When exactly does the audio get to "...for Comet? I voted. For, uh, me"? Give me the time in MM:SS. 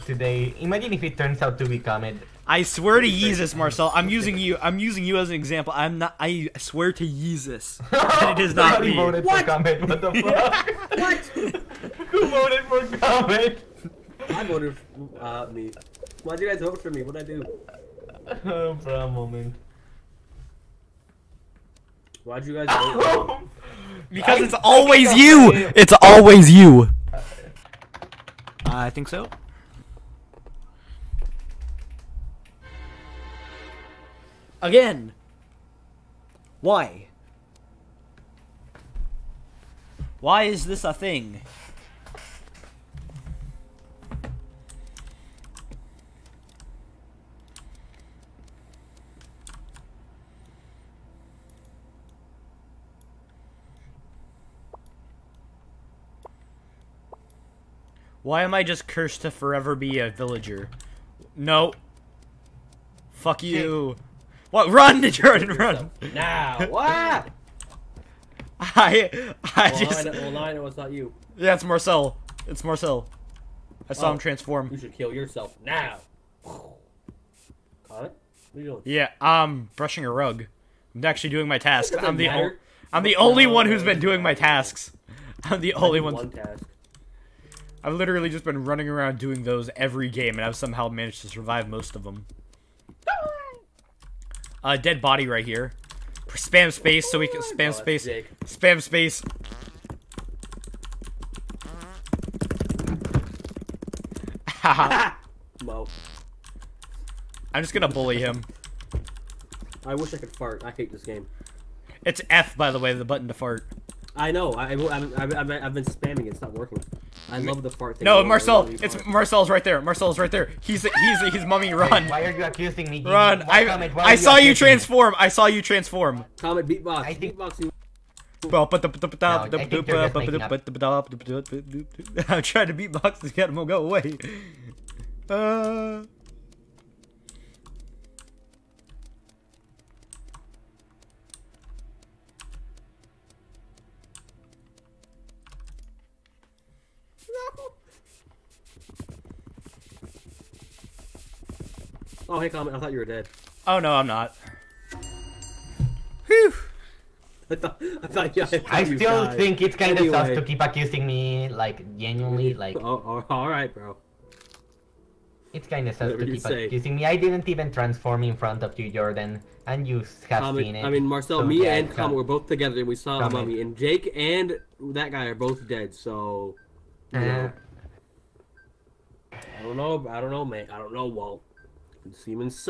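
00:12.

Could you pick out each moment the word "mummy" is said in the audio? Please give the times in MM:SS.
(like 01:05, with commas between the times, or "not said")
02:01, 02:53.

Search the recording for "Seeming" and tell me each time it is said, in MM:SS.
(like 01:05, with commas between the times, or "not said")
03:02.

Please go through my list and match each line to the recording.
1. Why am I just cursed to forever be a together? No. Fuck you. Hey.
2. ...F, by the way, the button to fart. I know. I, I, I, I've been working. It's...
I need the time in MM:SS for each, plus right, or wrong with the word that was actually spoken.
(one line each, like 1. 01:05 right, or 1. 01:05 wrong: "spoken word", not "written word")
1. 00:58 wrong: "villager", not "together"
2. 01:52 wrong: "spamming", not "working".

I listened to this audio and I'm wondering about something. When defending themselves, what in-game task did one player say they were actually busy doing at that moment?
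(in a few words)
Brushing a rug.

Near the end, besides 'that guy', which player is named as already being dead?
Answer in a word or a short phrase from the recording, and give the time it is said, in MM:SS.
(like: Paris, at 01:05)
Jake, at 02:53.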